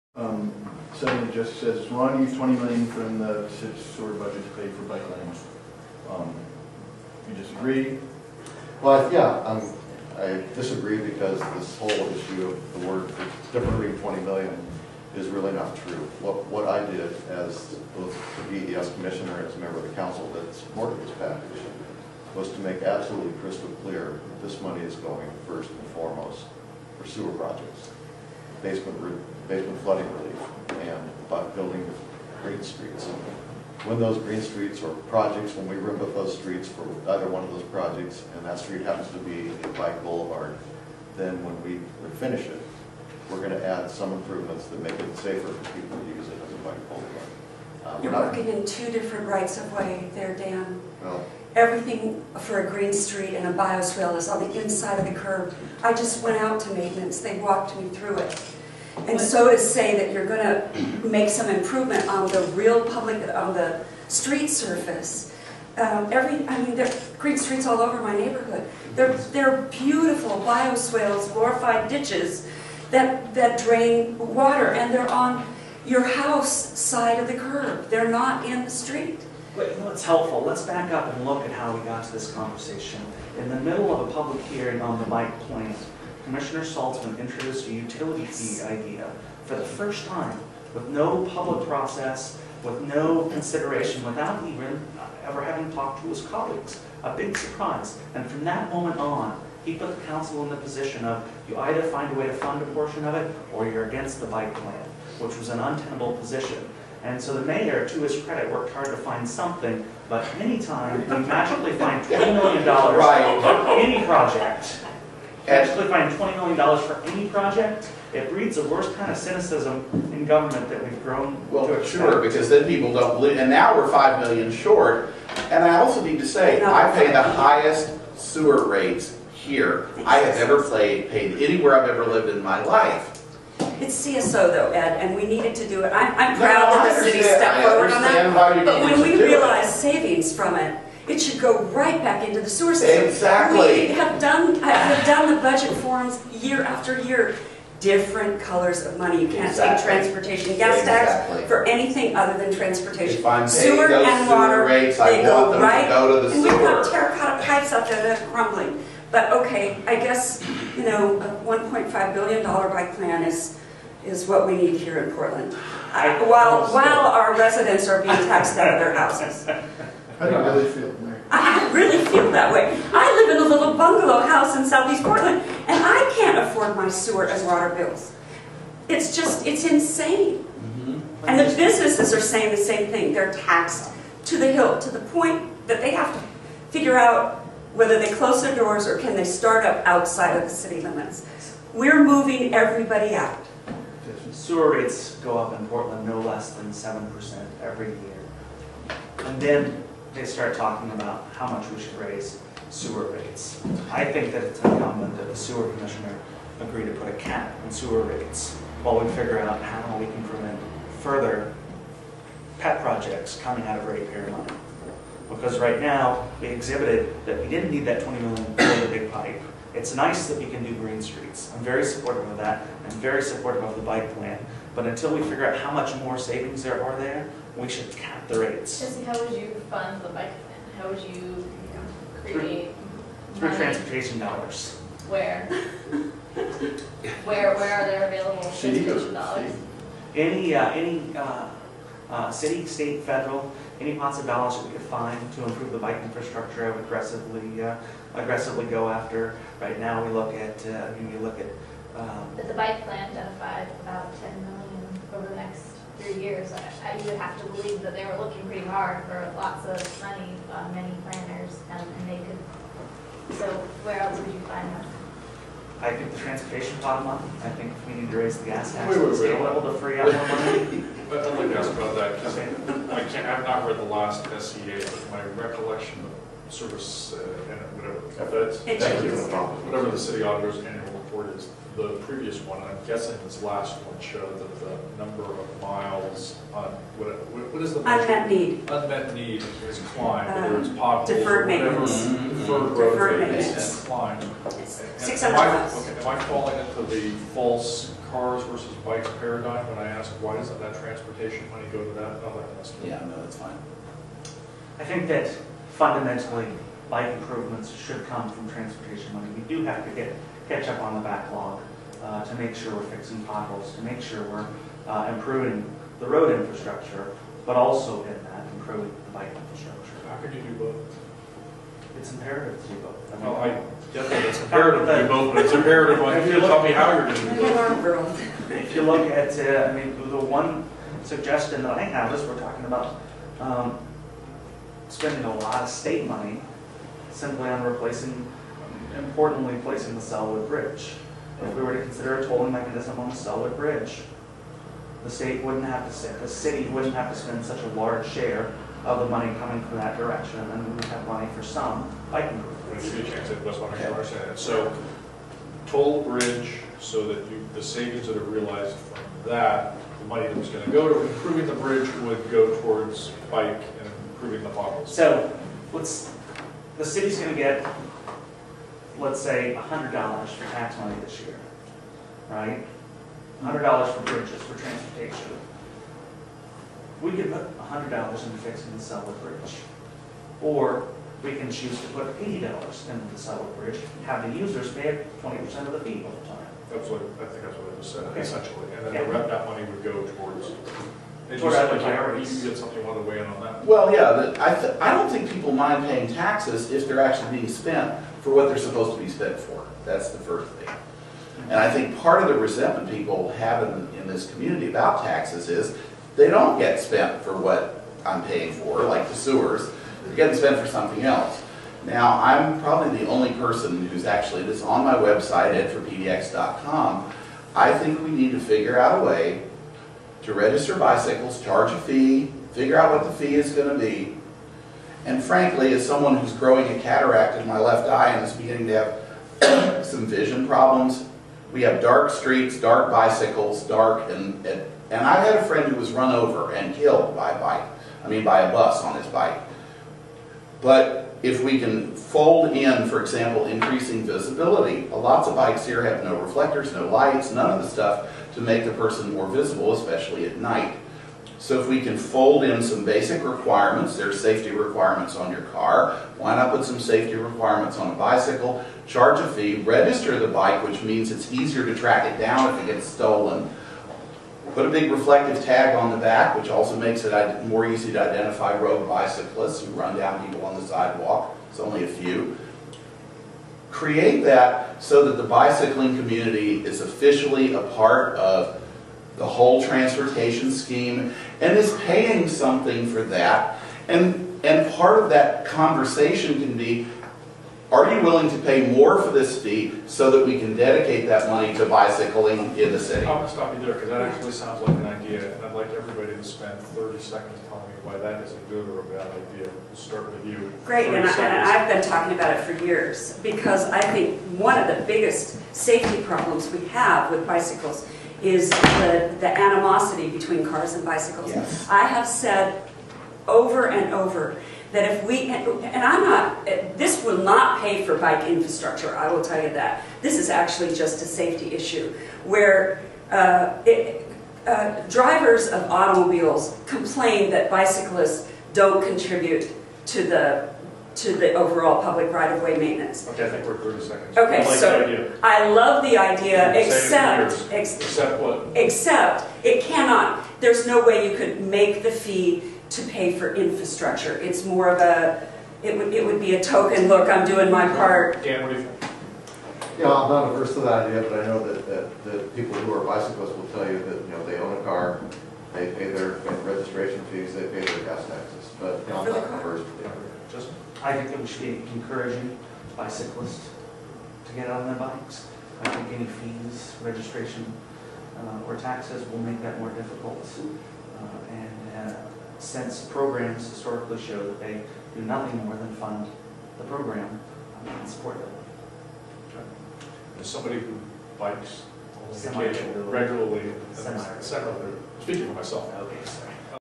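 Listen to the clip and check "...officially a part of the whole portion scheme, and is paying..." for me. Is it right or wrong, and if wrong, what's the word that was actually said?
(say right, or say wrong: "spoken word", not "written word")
wrong: "transportation", not "portion".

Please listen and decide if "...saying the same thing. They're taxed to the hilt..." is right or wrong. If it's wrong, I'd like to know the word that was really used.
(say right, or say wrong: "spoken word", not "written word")
right.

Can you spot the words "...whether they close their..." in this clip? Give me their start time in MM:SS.
03:07.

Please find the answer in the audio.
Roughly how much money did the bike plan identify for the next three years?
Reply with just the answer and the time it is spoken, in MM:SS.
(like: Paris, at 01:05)
10 million, at 04:14.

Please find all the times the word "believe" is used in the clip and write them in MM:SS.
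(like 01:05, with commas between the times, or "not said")
02:03, 04:17.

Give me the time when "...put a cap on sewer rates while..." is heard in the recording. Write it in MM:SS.
03:26.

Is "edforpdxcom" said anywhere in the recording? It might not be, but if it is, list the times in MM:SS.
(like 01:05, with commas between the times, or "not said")
06:55.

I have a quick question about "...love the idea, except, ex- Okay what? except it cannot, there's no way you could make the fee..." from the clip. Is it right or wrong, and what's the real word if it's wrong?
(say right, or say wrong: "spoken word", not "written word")
wrong: "Except", not "Okay".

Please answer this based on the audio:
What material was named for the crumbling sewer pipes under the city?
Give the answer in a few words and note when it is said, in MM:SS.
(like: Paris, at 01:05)
terracotta, at 02:36.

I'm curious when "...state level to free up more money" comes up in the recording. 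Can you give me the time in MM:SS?
04:29.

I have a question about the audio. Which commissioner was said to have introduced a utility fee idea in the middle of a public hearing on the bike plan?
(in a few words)
Saltzman.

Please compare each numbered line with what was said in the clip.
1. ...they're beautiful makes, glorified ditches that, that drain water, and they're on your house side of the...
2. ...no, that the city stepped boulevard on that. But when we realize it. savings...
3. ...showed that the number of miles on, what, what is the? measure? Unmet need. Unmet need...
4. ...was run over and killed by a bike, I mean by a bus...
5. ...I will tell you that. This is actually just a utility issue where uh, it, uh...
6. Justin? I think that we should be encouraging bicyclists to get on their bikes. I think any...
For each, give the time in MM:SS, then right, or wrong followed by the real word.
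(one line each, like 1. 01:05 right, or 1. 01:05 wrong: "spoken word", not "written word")
1. 01:09 wrong: "bioswales", not "makes"
2. 02:16 wrong: "forward", not "boulevard"
3. 04:43 right
4. 07:15 right
5. 08:38 wrong: "safety", not "utility"
6. 09:20 right.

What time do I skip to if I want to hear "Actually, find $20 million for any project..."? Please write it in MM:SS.
01:55.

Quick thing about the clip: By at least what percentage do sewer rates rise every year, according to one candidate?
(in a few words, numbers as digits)
7%.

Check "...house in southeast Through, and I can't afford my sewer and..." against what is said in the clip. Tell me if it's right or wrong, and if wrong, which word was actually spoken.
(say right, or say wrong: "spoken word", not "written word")
wrong: "Portland", not "Through".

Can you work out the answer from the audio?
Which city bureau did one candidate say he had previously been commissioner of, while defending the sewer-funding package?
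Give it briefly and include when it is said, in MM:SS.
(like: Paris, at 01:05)
BES, at 00:18.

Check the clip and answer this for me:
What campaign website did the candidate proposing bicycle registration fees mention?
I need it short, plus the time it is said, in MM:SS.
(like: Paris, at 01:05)
edforpdx.com, at 06:55.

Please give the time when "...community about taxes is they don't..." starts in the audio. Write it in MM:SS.
06:44.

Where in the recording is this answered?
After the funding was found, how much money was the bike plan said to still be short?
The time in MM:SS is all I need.
02:03.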